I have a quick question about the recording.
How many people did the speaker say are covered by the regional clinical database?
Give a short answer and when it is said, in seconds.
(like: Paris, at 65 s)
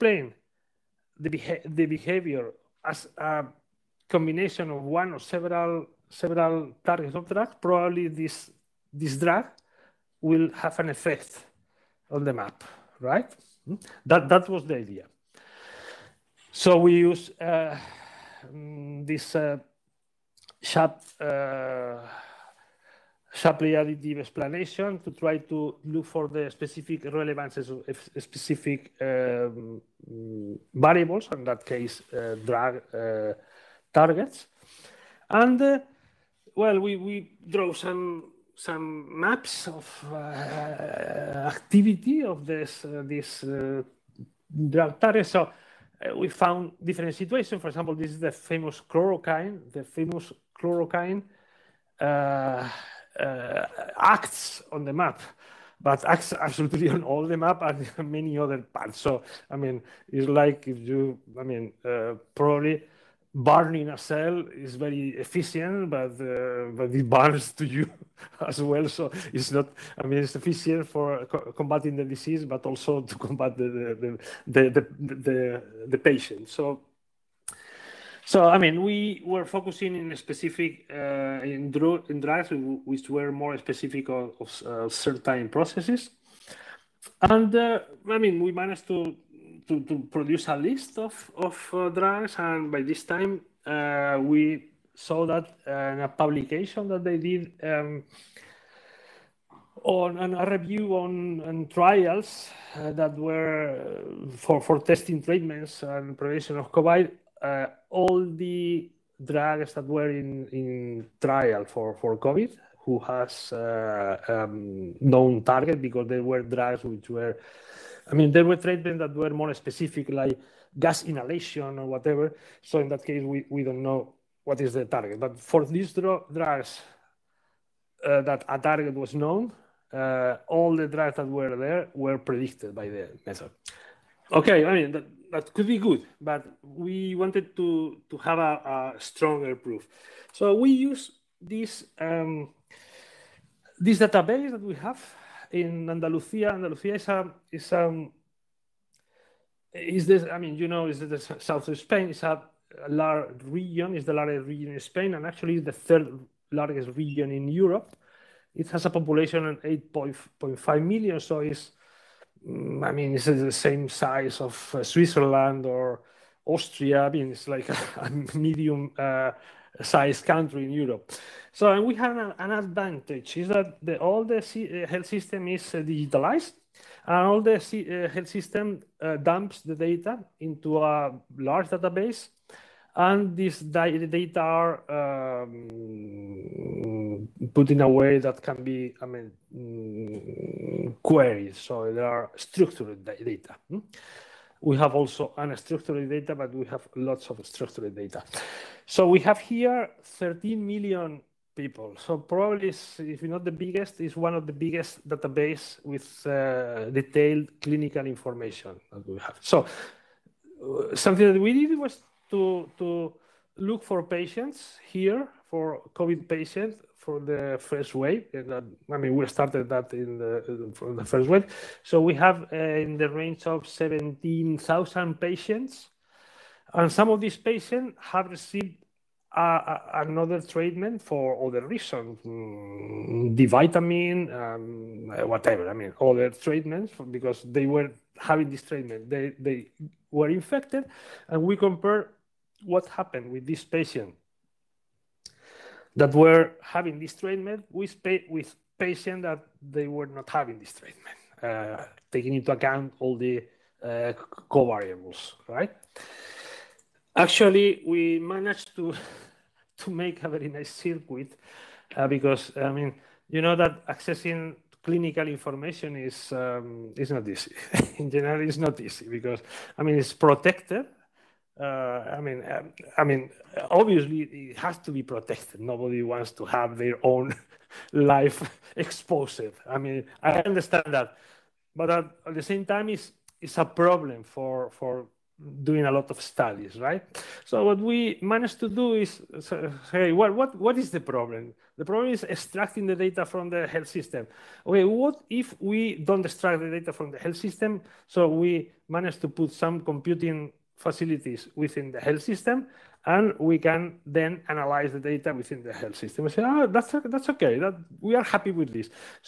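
13 million, at 200 s.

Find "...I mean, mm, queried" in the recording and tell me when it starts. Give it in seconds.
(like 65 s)
189 s.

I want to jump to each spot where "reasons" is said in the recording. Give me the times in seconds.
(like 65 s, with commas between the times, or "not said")
231 s.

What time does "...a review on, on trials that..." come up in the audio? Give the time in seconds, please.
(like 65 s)
100 s.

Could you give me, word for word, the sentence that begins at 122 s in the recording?
So in that case, we, we don't know what is the target.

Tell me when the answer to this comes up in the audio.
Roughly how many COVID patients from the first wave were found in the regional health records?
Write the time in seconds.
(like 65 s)
223 s.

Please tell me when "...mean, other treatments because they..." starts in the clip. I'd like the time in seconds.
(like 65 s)
235 s.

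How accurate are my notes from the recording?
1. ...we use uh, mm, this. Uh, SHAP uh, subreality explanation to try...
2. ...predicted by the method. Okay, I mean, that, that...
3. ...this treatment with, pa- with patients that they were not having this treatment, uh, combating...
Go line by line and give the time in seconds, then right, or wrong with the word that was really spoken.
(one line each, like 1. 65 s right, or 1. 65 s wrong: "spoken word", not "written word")
1. 16 s right
2. 132 s right
3. 246 s wrong: "taking", not "combating".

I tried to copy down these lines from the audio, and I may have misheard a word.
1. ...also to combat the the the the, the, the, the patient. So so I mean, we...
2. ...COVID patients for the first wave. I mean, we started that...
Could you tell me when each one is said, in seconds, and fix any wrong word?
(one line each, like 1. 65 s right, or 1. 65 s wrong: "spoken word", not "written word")
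1. 72 s right
2. 215 s right.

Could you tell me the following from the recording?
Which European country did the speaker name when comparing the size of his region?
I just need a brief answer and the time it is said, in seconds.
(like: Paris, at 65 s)
Switzerland, at 164 s.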